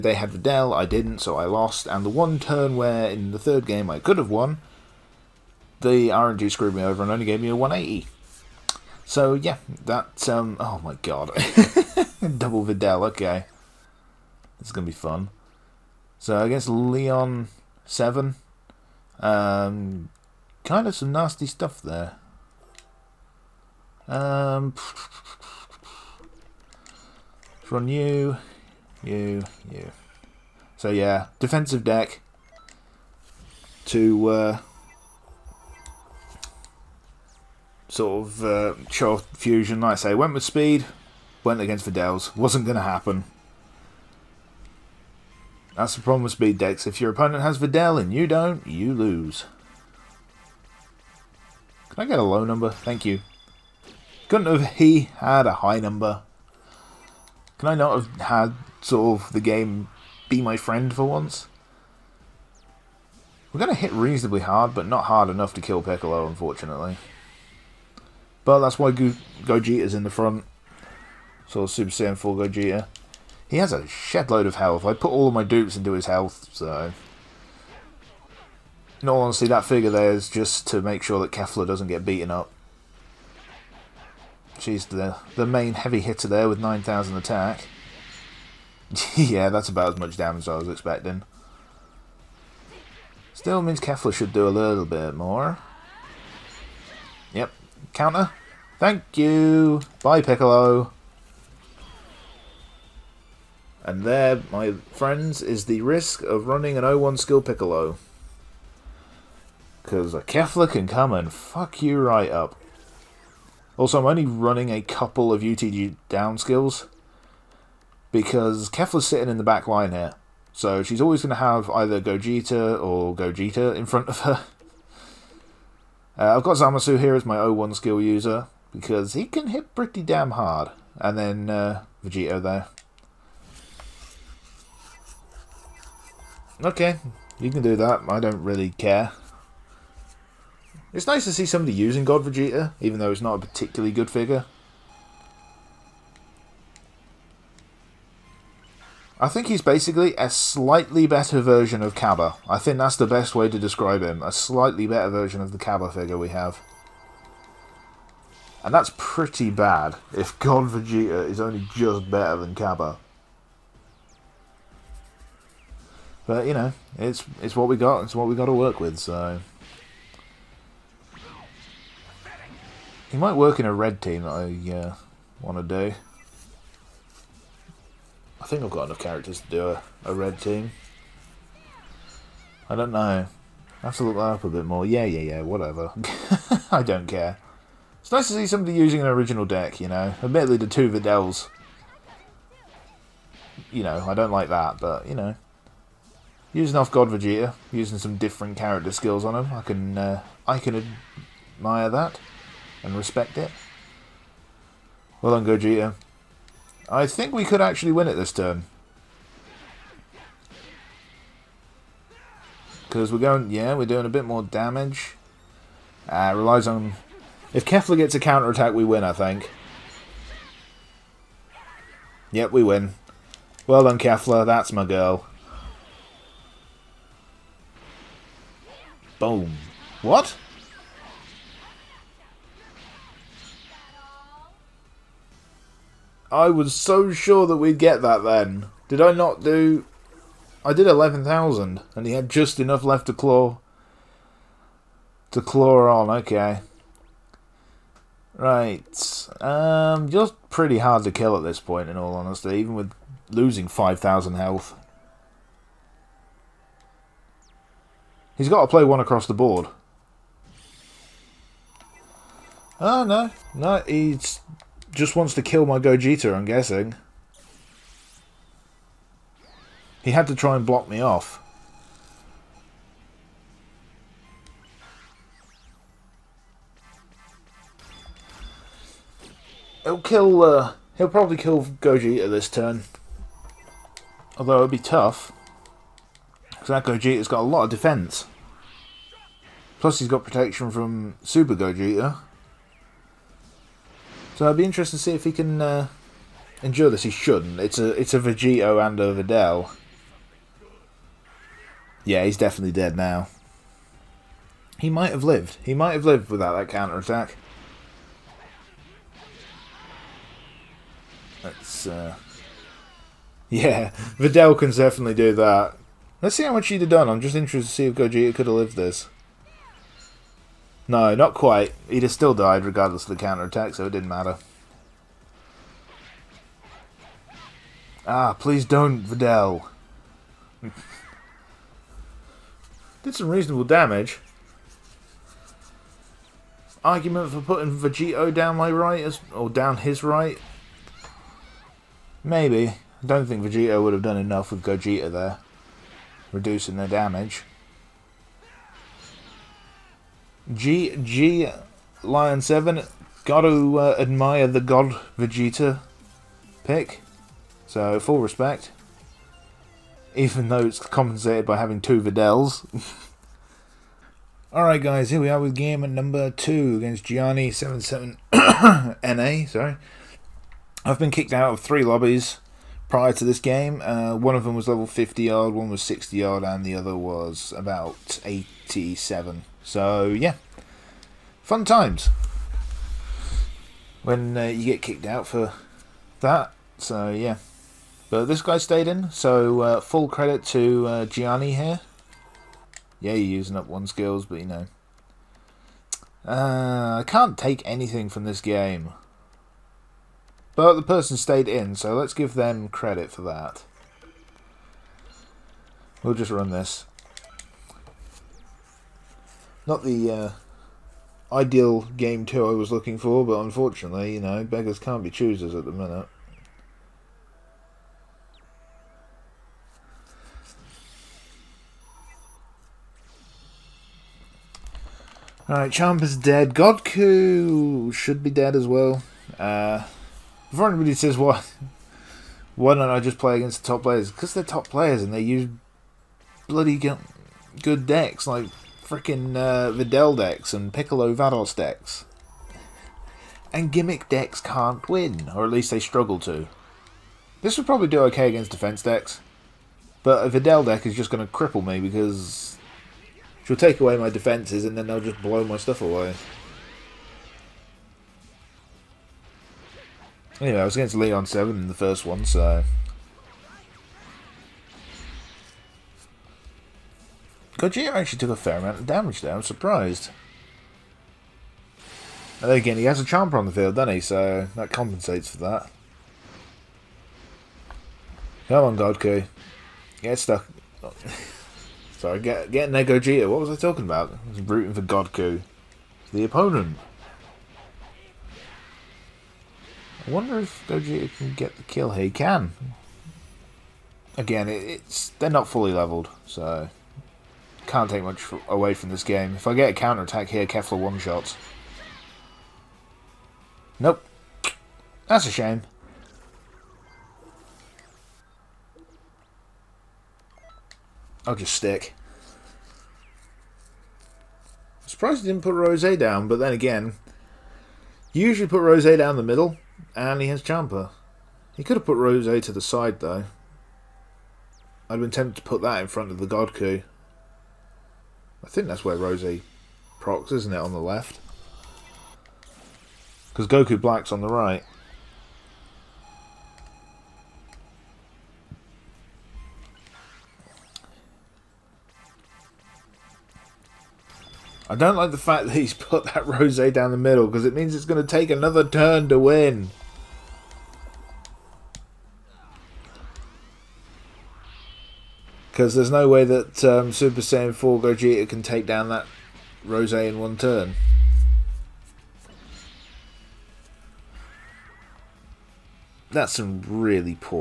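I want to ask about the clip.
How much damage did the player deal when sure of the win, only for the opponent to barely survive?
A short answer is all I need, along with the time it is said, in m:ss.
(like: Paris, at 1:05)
11,000, at 4:00.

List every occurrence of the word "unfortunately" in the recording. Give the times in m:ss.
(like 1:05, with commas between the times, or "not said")
1:06, 6:53.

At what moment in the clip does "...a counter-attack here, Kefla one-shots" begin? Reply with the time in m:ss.
8:19.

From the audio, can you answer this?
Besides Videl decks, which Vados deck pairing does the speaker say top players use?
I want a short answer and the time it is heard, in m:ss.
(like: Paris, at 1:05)
Piccolo Vados, at 7:20.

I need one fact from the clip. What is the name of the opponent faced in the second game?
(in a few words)
Gianni77NA.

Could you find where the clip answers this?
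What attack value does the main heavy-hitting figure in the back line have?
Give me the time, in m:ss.
1:26.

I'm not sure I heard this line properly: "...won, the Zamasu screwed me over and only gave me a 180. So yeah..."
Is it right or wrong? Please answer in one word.
wrong.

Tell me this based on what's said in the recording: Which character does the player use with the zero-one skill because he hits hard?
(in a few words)
Zamasu.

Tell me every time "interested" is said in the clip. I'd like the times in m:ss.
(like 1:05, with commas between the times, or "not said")
4:54, 5:17.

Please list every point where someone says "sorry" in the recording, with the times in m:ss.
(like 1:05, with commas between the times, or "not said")
6:09, 8:01.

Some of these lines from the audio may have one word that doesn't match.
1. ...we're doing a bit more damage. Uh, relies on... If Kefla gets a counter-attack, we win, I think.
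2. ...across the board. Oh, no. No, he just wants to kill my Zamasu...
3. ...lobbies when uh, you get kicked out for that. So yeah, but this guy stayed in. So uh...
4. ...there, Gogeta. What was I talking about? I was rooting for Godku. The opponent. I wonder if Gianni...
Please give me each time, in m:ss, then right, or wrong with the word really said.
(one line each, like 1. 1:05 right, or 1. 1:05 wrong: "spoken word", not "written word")
1. 3:33 right
2. 4:18 wrong: "Gogeta", not "Zamasu"
3. 6:21 wrong: "times", not "lobbies"
4. 8:02 wrong: "Gogeta", not "Gianni".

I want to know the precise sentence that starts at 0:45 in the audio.
That's the problem with speed decks.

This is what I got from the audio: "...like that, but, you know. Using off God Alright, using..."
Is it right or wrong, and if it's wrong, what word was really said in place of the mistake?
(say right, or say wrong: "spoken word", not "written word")
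wrong: "Vegeta", not "Alright".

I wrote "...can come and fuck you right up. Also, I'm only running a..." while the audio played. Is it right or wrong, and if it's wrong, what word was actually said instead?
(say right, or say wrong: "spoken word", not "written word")
right.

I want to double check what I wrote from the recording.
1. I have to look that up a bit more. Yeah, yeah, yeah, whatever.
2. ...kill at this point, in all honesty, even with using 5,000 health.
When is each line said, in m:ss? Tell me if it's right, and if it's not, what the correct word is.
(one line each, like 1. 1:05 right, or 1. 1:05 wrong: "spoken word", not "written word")
1. 3:03 right
2. 4:11 wrong: "losing", not "using".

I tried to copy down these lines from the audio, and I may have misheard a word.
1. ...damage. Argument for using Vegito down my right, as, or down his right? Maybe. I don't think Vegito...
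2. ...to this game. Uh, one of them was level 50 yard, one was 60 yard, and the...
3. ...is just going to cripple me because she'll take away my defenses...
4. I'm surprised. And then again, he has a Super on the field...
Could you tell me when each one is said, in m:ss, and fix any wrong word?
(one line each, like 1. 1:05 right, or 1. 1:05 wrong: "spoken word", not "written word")
1. 5:33 wrong: "putting", not "using"
2. 6:13 right
3. 7:30 right
4. 7:49 wrong: "Champa", not "Super".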